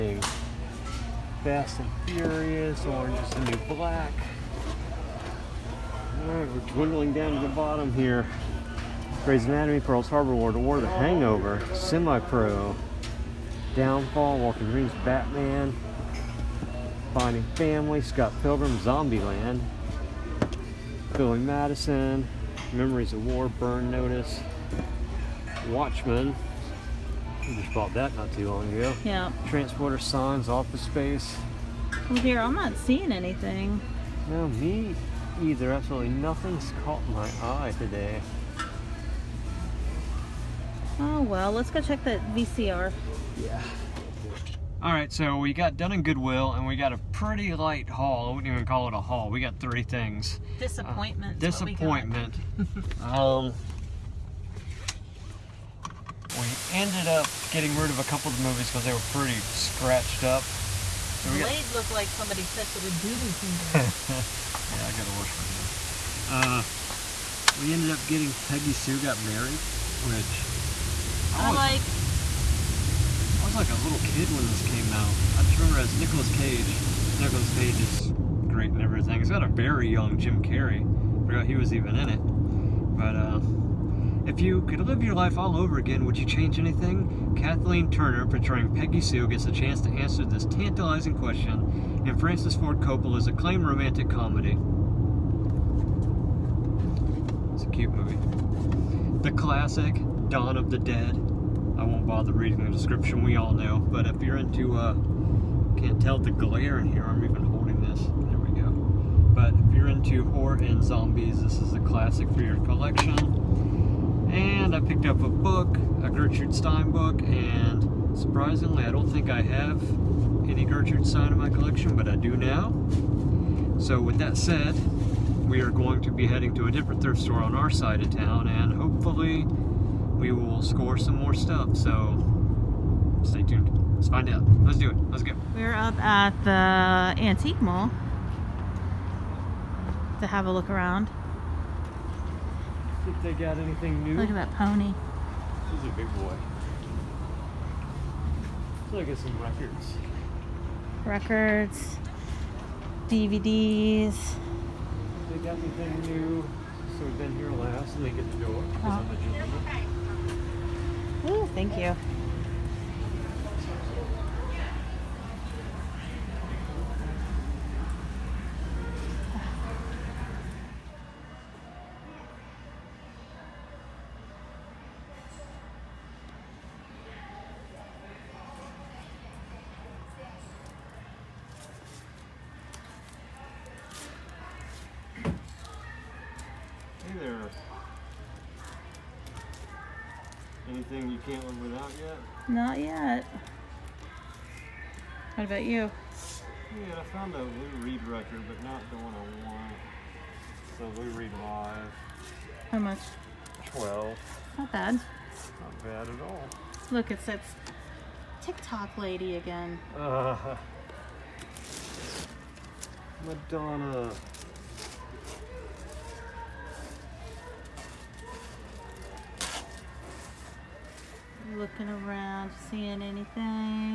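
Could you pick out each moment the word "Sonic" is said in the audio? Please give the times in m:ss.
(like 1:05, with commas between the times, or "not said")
not said.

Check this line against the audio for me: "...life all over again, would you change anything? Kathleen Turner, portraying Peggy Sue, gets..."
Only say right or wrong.
right.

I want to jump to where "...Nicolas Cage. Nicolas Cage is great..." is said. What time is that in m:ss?
1:15.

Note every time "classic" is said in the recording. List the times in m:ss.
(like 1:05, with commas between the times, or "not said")
1:39, 1:51.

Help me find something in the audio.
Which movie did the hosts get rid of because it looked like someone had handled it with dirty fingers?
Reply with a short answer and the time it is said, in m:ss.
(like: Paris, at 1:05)
Blade, at 1:01.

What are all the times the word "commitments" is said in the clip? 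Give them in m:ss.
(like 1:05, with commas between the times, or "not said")
not said.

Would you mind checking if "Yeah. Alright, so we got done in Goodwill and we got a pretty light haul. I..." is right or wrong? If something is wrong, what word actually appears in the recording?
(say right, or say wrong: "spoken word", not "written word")
right.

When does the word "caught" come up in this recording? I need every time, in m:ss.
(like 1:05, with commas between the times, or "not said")
0:36.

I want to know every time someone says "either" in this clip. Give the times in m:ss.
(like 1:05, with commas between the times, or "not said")
0:35.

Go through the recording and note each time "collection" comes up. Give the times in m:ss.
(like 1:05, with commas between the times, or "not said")
1:52, 2:01.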